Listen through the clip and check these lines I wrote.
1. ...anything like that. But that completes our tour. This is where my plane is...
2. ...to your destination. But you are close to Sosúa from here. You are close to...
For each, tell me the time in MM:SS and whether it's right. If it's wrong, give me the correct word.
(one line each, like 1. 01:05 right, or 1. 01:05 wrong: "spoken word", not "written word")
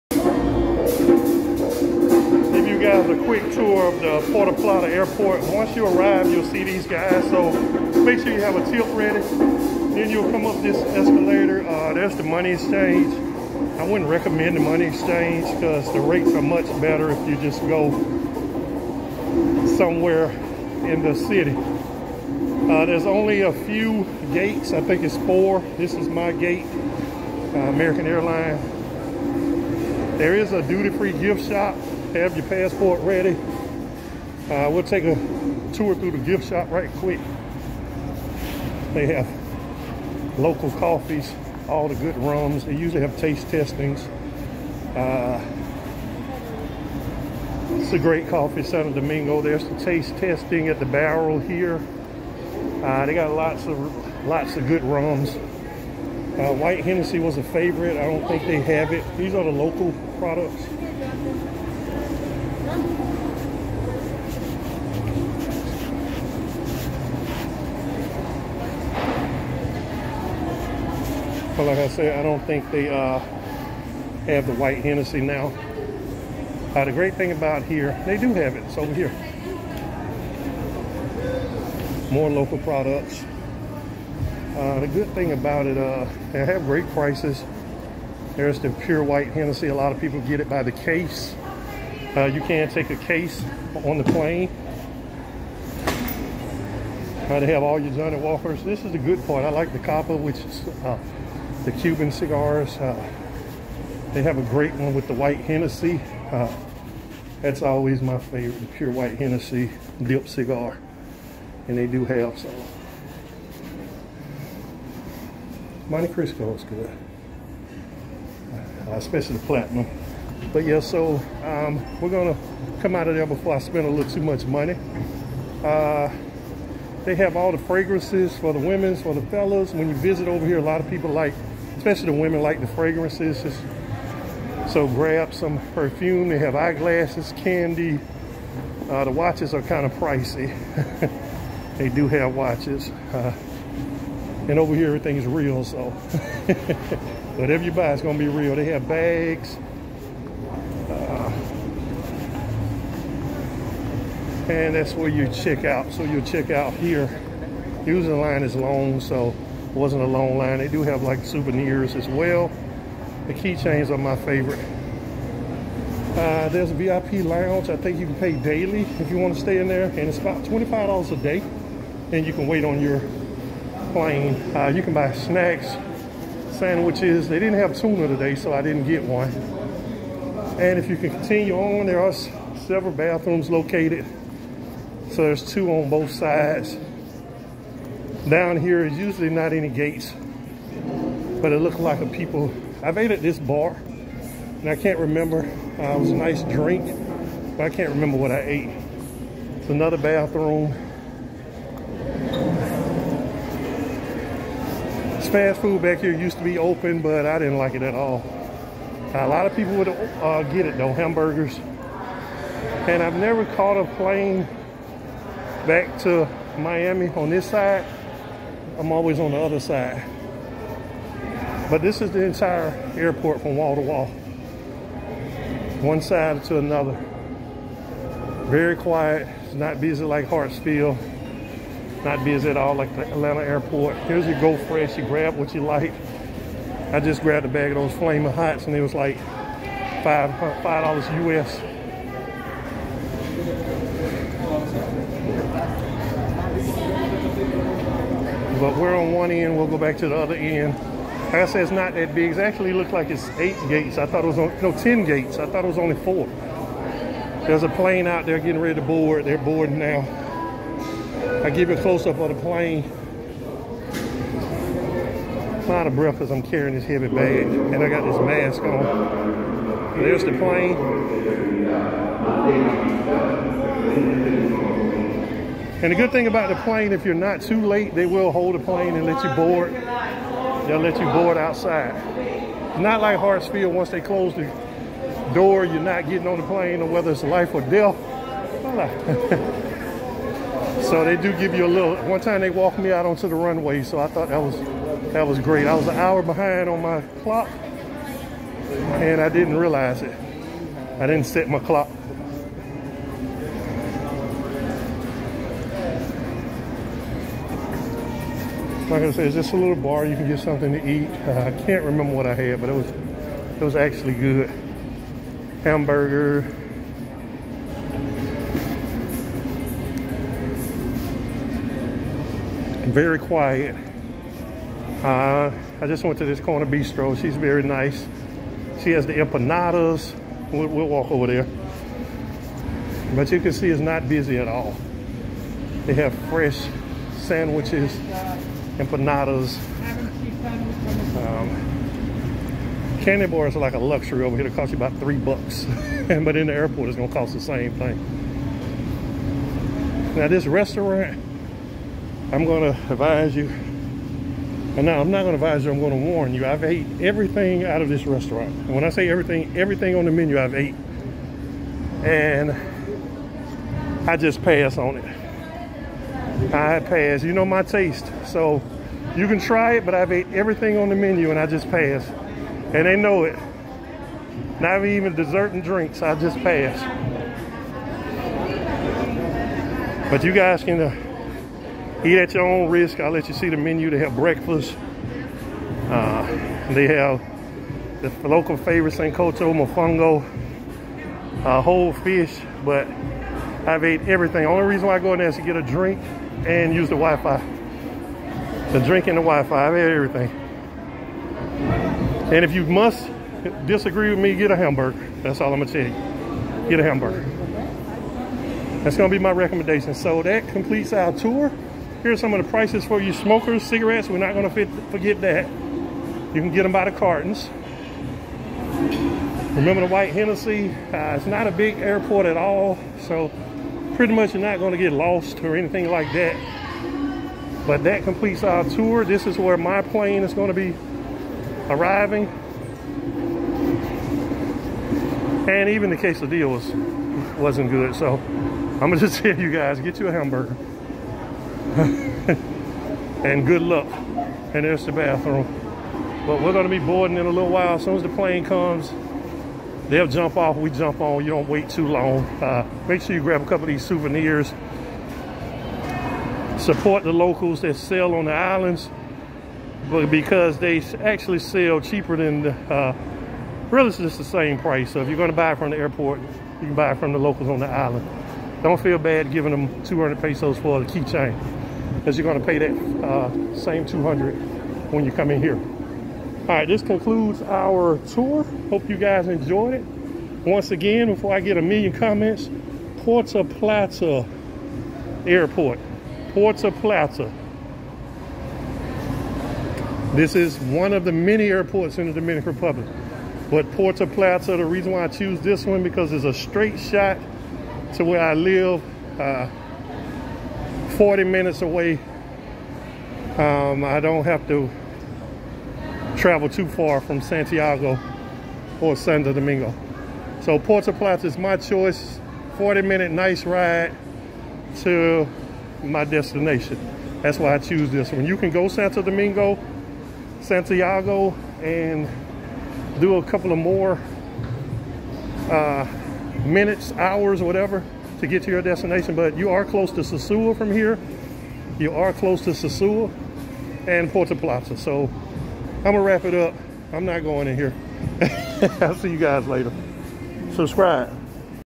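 1. 07:05 right
2. 08:48 right.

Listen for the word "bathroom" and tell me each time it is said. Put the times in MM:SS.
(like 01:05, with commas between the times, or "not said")
03:02, 03:19, 07:24.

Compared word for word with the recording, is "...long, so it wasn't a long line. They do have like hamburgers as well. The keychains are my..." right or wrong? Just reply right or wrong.
wrong.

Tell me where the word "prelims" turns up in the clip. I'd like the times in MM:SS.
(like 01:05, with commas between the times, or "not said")
not said.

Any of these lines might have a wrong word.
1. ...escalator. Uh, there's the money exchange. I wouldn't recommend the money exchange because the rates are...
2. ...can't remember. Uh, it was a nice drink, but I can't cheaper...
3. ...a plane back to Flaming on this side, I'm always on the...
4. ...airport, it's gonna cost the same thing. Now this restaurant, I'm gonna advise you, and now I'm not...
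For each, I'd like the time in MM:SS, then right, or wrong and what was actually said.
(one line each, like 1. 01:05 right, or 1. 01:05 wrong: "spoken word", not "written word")
1. 00:10 right
2. 03:14 wrong: "remember", not "cheaper"
3. 03:33 wrong: "Miami", not "Flaming"
4. 05:46 right.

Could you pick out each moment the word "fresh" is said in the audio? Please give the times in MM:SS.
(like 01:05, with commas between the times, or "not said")
03:54, 05:36.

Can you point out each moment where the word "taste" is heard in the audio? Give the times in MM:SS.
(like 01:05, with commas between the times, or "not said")
00:43, 00:49, 06:07.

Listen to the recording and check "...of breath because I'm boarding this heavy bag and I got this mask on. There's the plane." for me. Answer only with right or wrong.
wrong.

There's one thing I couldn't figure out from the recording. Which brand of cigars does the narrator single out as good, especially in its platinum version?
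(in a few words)
Montecristo.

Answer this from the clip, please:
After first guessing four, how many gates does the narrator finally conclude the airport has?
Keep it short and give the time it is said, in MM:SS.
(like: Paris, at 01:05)
10, at 04:14.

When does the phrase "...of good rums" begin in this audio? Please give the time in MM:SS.
00:54.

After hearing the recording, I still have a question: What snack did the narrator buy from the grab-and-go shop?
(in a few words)
Flaming Hots.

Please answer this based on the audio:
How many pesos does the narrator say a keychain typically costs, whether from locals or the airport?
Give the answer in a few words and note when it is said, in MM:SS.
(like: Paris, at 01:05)
200 pesos, at 07:49.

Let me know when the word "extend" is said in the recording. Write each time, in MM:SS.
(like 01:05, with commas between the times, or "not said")
not said.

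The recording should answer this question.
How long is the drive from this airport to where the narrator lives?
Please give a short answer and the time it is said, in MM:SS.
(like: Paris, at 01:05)
40 minutes, at 08:20.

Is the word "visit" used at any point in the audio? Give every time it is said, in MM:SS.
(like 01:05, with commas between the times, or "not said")
02:09.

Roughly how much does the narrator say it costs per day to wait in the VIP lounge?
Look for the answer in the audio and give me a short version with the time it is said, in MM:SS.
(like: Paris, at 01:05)
$25, at 02:50.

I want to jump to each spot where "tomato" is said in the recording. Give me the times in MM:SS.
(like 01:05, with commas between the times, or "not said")
not said.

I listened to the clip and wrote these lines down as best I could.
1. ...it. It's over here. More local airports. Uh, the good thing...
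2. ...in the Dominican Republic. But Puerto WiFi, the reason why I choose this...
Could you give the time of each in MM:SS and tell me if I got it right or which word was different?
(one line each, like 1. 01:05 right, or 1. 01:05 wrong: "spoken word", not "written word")
1. 01:18 wrong: "products", not "airports"
2. 08:11 wrong: "Plata", not "WiFi".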